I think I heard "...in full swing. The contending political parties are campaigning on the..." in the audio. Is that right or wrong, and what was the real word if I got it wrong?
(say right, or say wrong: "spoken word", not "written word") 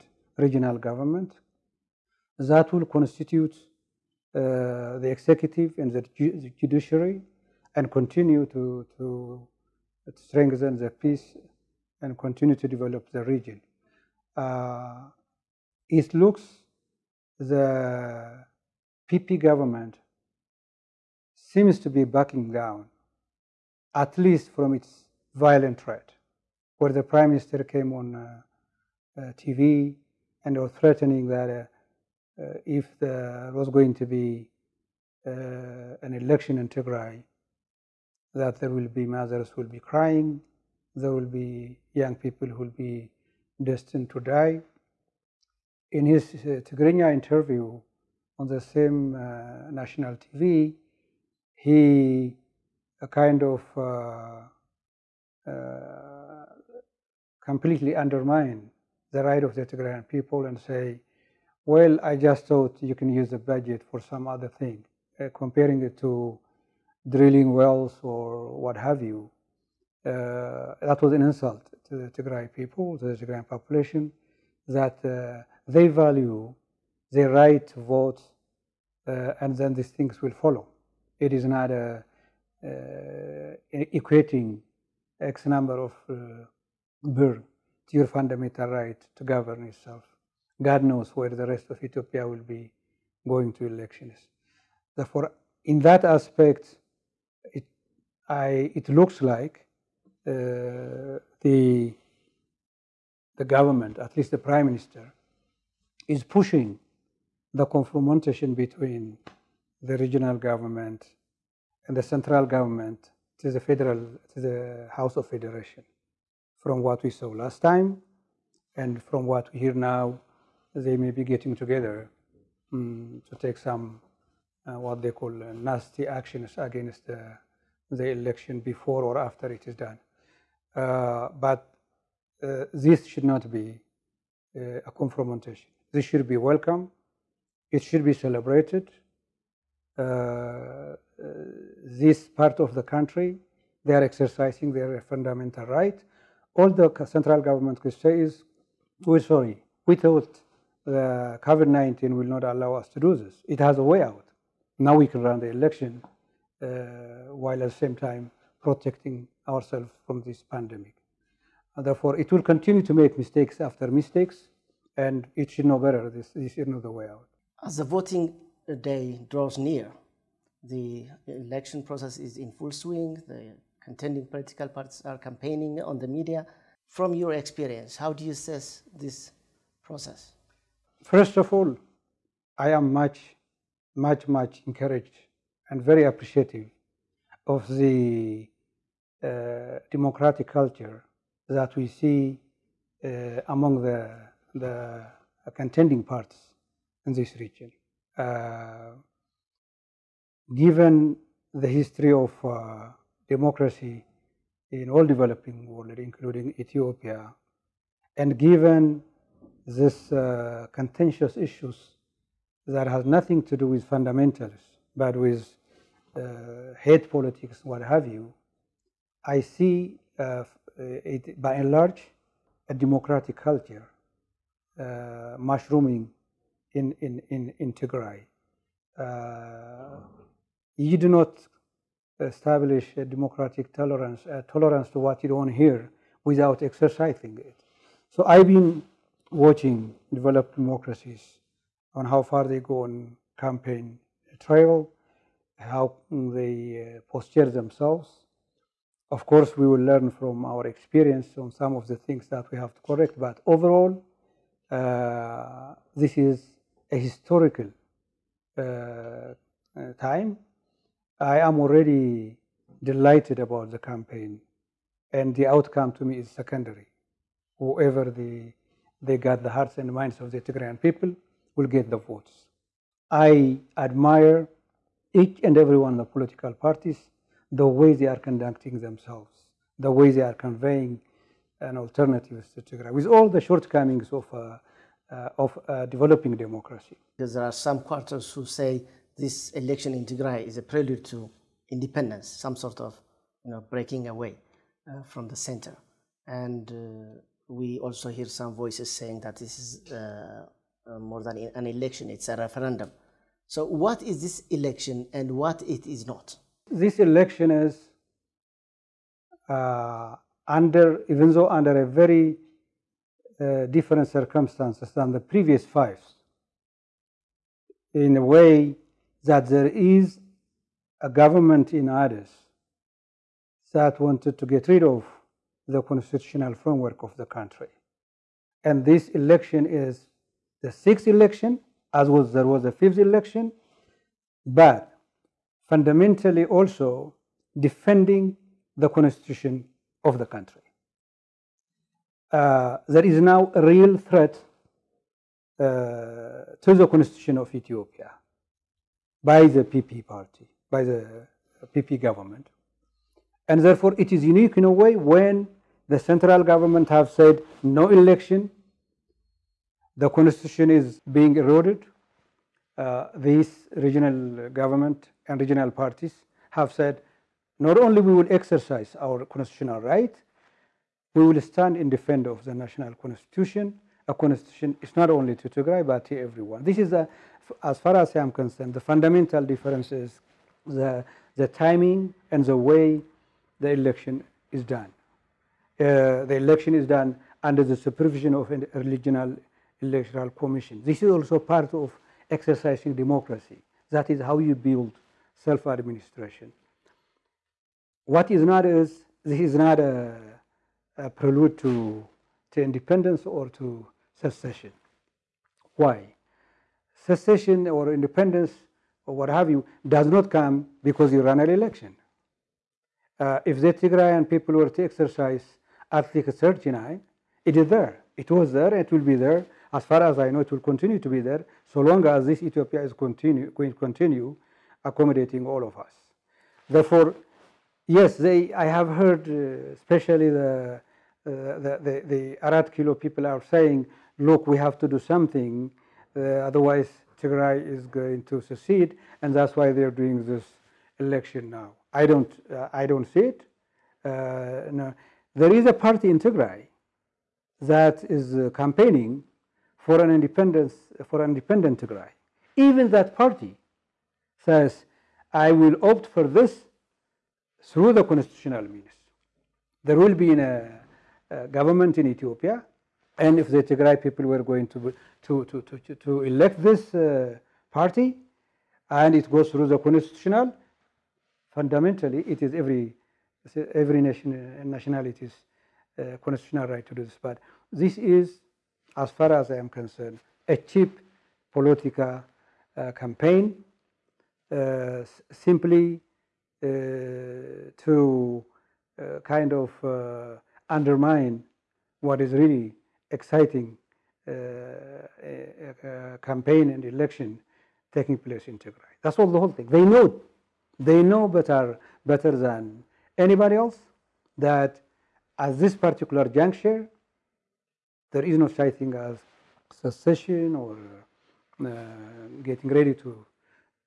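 right.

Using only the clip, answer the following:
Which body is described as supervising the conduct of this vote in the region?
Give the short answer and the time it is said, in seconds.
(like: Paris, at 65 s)
regional electoral commission, at 388 s.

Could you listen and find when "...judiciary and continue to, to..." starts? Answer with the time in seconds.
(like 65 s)
6 s.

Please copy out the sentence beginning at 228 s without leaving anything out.
Uh, you do not establish a democratic tolerance, a tolerance to what you don't hear without exercising it.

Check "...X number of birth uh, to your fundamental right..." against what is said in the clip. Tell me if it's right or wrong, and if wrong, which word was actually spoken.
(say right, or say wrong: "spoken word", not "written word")
right.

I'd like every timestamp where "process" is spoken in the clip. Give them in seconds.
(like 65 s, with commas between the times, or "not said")
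171 s, 179 s.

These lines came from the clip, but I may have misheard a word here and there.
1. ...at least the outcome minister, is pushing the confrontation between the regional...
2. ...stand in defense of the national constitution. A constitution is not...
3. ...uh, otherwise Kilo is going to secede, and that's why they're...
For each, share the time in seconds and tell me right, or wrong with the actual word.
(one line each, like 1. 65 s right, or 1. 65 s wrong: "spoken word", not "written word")
1. 103 s wrong: "prime", not "outcome"
2. 371 s right
3. 436 s wrong: "Tigray", not "Kilo".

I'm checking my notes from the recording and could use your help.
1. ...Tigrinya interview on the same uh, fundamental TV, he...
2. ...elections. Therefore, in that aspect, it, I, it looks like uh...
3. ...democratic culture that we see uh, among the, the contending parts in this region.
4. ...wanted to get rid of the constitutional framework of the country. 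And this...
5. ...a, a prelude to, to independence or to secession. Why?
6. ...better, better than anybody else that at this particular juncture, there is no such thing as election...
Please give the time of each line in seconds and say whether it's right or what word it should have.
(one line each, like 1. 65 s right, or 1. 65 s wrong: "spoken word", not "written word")
1. 46 s wrong: "national", not "fundamental"
2. 93 s right
3. 189 s right
4. 323 s right
5. 399 s right
6. 501 s wrong: "secession", not "election".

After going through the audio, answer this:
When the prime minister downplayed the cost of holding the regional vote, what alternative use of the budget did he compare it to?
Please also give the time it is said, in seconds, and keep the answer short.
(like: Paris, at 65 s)
drilling wells, at 67 s.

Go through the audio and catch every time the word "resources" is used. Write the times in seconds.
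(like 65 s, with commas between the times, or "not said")
not said.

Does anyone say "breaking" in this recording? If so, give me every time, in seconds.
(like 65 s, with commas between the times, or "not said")
293 s.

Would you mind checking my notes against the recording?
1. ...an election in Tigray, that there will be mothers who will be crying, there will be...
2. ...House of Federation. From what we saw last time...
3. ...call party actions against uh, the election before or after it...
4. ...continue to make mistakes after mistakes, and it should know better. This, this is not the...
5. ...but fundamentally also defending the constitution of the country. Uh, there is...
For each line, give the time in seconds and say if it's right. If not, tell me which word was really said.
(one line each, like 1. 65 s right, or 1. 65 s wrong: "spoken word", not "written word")
1. 36 s right
2. 114 s right
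3. 125 s wrong: "nasty", not "party"
4. 162 s right
5. 334 s right.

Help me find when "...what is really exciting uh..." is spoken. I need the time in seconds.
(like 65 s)
492 s.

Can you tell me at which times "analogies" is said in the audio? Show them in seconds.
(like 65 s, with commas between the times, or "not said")
not said.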